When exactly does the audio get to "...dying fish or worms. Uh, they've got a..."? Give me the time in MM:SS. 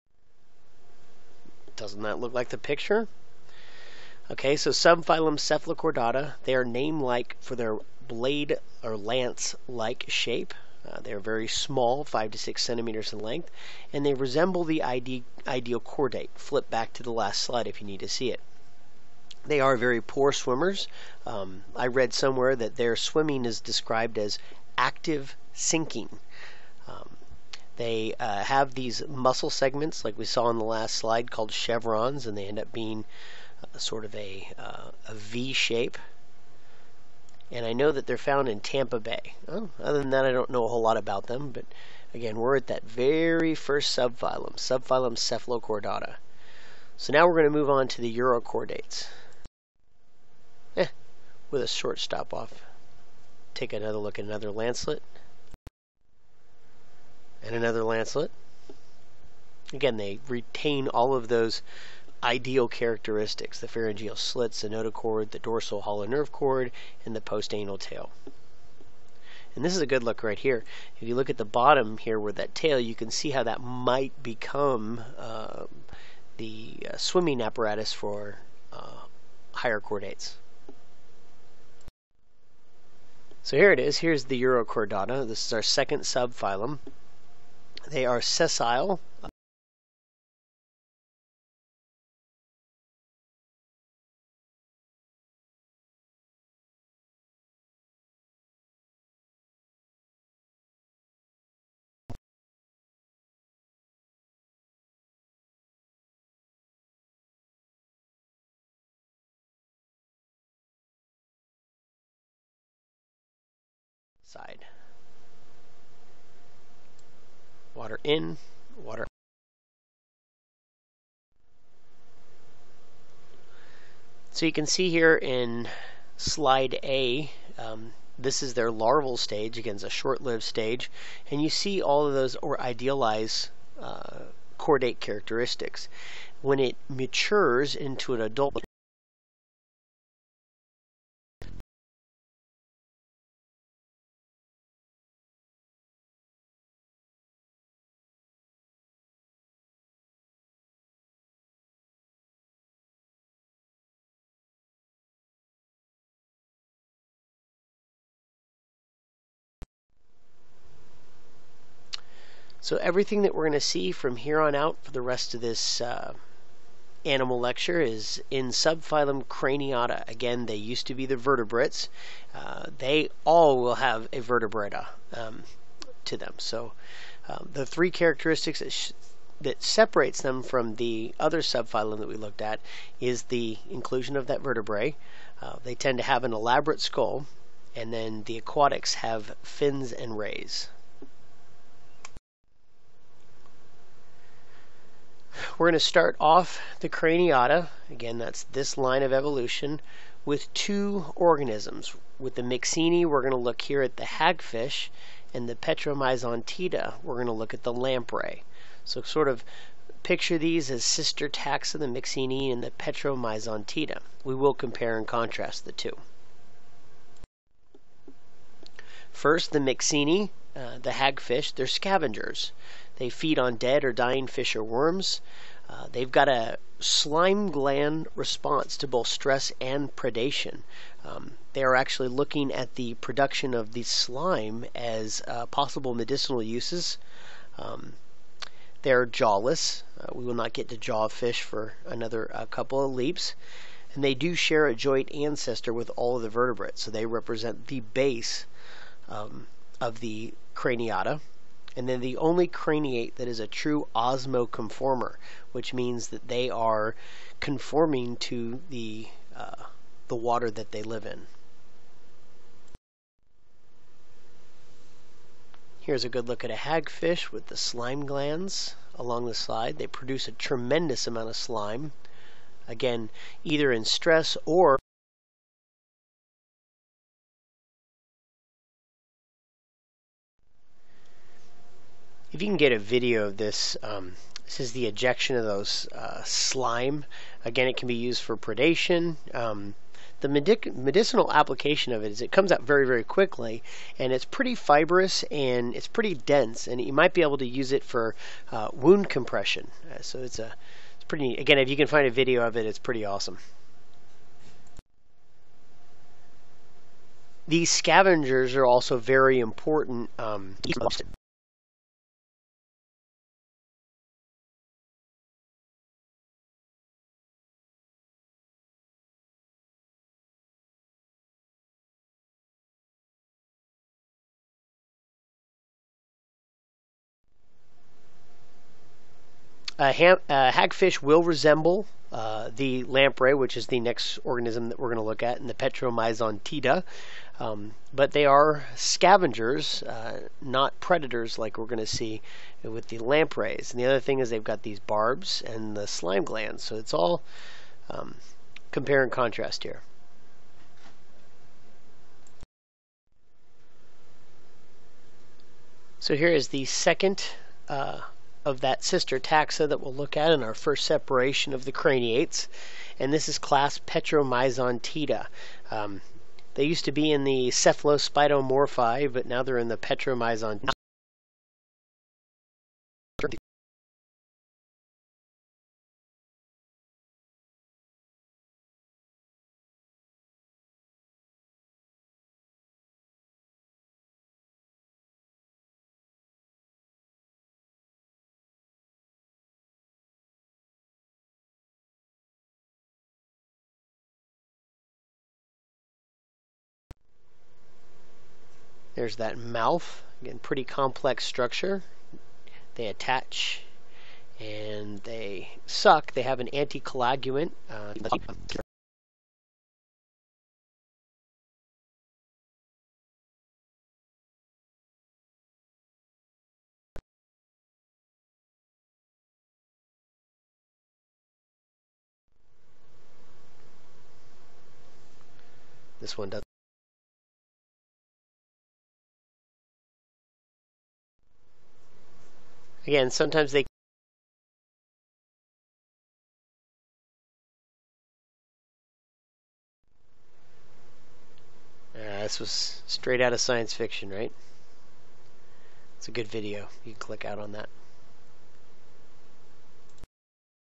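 03:43.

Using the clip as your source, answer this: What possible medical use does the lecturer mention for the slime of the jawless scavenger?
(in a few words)
wound compression.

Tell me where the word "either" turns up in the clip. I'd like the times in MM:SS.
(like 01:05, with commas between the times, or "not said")
04:33.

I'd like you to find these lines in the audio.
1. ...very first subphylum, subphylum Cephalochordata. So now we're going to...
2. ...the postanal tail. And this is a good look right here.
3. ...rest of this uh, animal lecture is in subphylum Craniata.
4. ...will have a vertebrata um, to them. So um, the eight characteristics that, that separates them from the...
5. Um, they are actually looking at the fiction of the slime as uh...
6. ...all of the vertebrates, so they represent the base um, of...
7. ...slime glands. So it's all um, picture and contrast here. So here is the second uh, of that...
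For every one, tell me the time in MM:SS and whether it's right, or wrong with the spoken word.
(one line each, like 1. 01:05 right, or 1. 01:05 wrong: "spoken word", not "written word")
1. 00:42 right
2. 01:07 right
3. 02:45 right
4. 02:53 wrong: "three", not "eight"
5. 03:51 wrong: "production", not "fiction"
6. 04:05 right
7. 05:45 wrong: "compare", not "picture".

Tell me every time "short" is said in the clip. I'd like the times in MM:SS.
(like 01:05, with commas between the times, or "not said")
00:51, 02:09.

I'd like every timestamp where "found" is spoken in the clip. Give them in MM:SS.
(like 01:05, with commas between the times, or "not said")
00:38.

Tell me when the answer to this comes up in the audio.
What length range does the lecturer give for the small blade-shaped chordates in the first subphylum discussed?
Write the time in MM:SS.
00:12.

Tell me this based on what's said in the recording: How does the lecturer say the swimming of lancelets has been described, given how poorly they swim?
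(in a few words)
active sinking.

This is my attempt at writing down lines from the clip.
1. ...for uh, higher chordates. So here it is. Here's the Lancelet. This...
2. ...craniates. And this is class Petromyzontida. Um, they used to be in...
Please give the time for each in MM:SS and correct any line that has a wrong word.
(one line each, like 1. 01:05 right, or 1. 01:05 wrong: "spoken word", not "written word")
1. 01:17 wrong: "Urochordata", not "Lancelet"
2. 06:01 right.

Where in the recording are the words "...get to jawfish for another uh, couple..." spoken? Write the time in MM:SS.
04:00.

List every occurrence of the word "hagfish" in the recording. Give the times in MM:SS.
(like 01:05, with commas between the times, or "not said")
03:24, 03:40, 04:26, 05:30.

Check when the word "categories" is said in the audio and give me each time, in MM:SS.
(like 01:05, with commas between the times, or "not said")
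not said.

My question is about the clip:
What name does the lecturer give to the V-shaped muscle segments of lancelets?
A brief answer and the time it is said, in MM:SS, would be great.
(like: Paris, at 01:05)
chevrons, at 00:31.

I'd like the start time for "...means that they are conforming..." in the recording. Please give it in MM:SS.
04:15.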